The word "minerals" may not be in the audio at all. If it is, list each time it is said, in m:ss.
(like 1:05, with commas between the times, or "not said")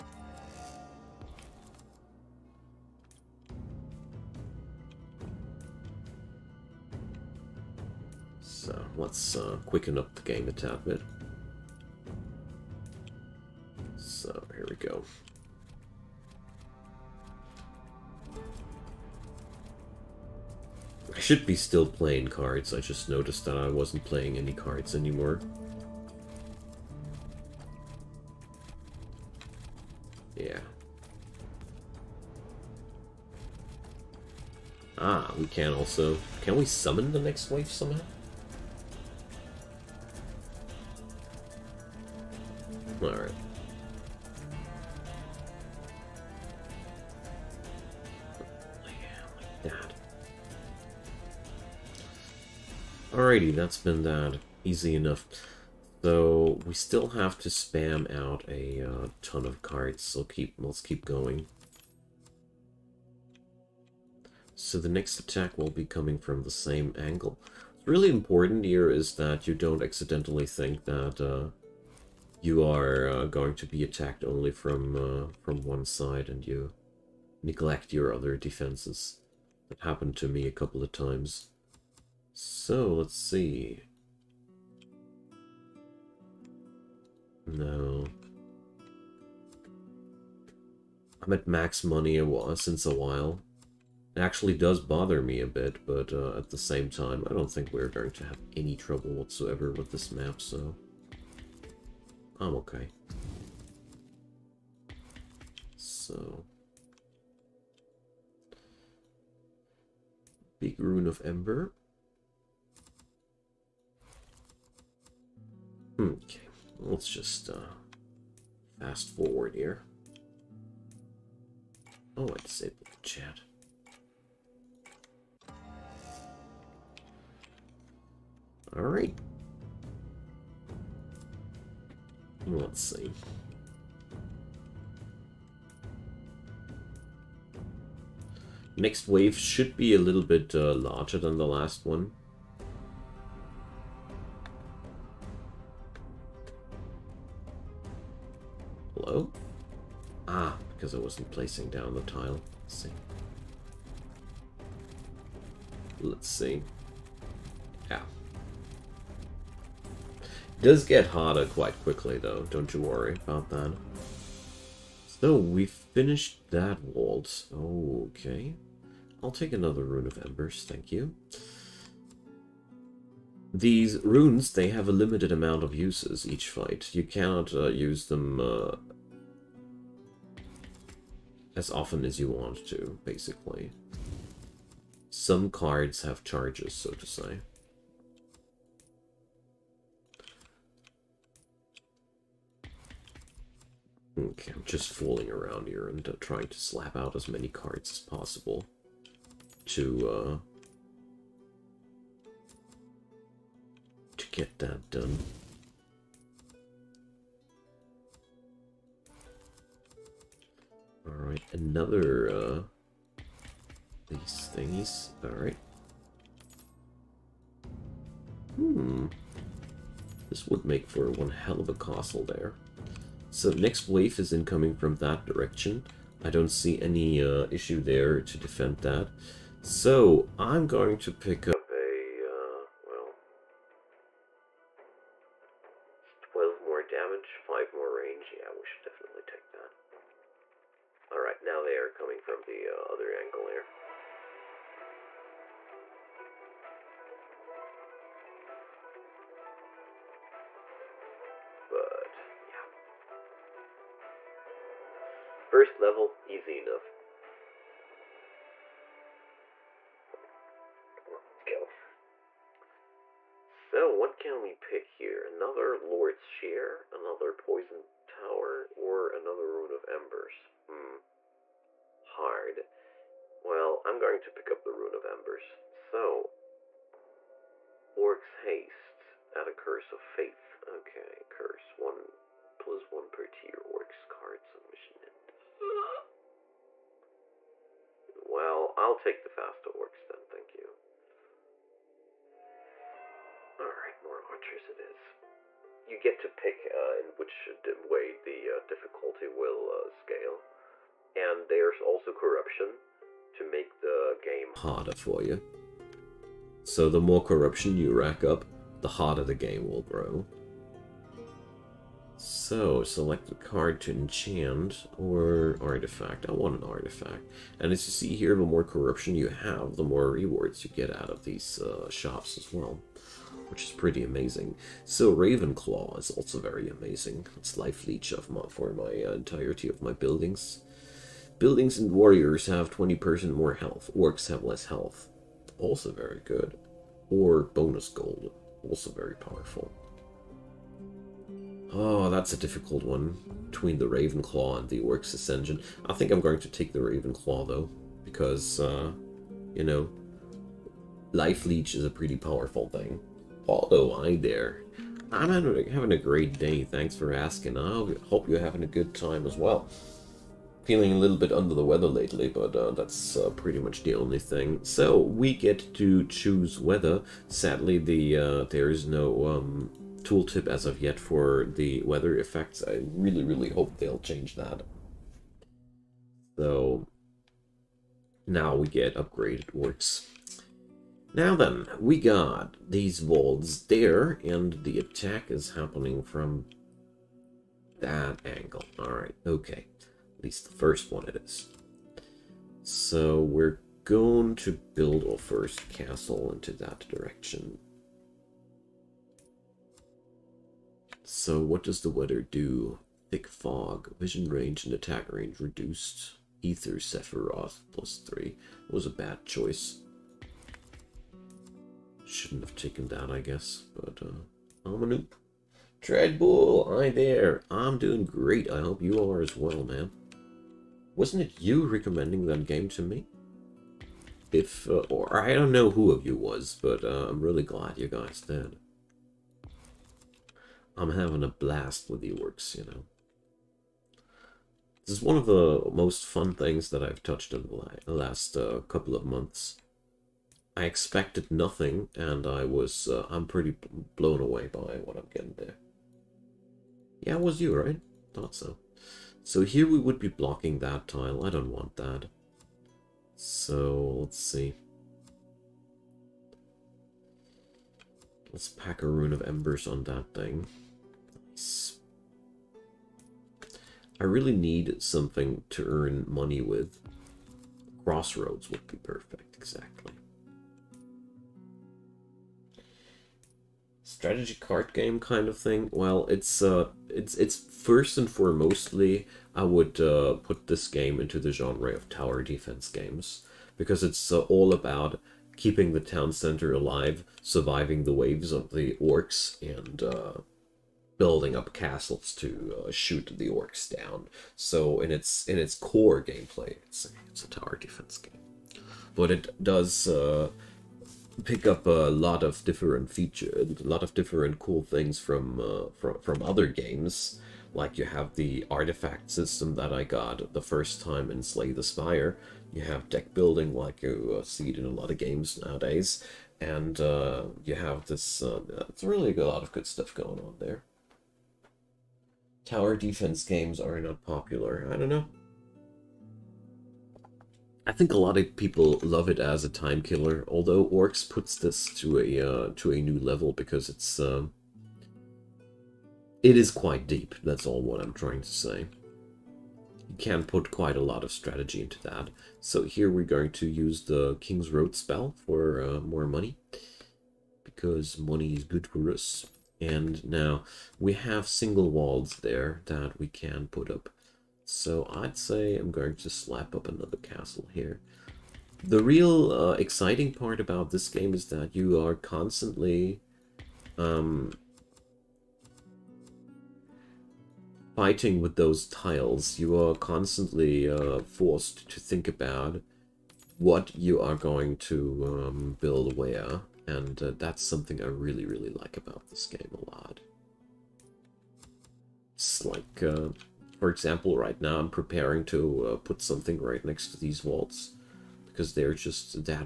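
not said.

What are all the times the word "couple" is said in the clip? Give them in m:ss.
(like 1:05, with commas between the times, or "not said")
1:20, 7:18.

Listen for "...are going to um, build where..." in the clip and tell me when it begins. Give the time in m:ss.
9:34.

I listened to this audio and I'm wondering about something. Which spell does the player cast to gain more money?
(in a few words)
King's Road.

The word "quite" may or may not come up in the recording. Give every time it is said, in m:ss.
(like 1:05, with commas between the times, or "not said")
2:41, 8:56, 9:00.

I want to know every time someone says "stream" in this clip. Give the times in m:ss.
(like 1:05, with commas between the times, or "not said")
not said.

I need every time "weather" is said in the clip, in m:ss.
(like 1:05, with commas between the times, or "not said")
6:01, 6:06, 6:11, 6:41.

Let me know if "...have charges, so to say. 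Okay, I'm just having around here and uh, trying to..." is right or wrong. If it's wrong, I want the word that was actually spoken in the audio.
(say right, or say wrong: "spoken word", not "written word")
wrong: "fooling", not "having".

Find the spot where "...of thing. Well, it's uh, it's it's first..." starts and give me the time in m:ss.
7:55.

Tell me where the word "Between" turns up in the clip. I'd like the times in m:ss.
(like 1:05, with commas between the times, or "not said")
5:43.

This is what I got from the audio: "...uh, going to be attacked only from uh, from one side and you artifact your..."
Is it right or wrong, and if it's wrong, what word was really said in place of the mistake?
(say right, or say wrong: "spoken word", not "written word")
wrong: "neglect", not "artifact".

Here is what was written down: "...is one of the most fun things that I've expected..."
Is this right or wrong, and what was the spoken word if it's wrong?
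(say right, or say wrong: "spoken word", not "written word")
wrong: "touched", not "expected".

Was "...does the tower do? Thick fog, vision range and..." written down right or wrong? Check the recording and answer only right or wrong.
wrong.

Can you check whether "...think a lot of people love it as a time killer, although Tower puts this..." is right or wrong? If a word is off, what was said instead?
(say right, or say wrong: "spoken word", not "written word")
wrong: "Orx", not "Tower".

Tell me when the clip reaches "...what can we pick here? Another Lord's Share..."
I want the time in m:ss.
4:23.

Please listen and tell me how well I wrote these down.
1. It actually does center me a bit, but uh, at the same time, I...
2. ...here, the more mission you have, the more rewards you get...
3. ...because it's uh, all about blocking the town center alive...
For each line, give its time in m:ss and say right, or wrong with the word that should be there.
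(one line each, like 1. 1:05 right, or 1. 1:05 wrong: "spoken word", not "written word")
1. 1:34 wrong: "bother", not "center"
2. 5:18 wrong: "corruption", not "mission"
3. 8:03 wrong: "keeping", not "blocking".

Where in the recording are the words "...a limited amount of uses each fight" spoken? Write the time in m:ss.
2:54.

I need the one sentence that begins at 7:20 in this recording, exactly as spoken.
I expected nothing, and I was, uh, I'm pretty blown away by what I'm getting there.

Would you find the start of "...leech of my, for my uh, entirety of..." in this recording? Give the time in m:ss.
5:27.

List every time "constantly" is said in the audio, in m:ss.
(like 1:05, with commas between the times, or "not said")
9:21, 9:29.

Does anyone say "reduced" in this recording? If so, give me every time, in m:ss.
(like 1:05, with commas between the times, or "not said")
6:45.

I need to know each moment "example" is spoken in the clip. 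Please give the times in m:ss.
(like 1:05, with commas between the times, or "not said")
9:43.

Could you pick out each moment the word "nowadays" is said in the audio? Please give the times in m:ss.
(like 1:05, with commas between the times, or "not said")
8:35.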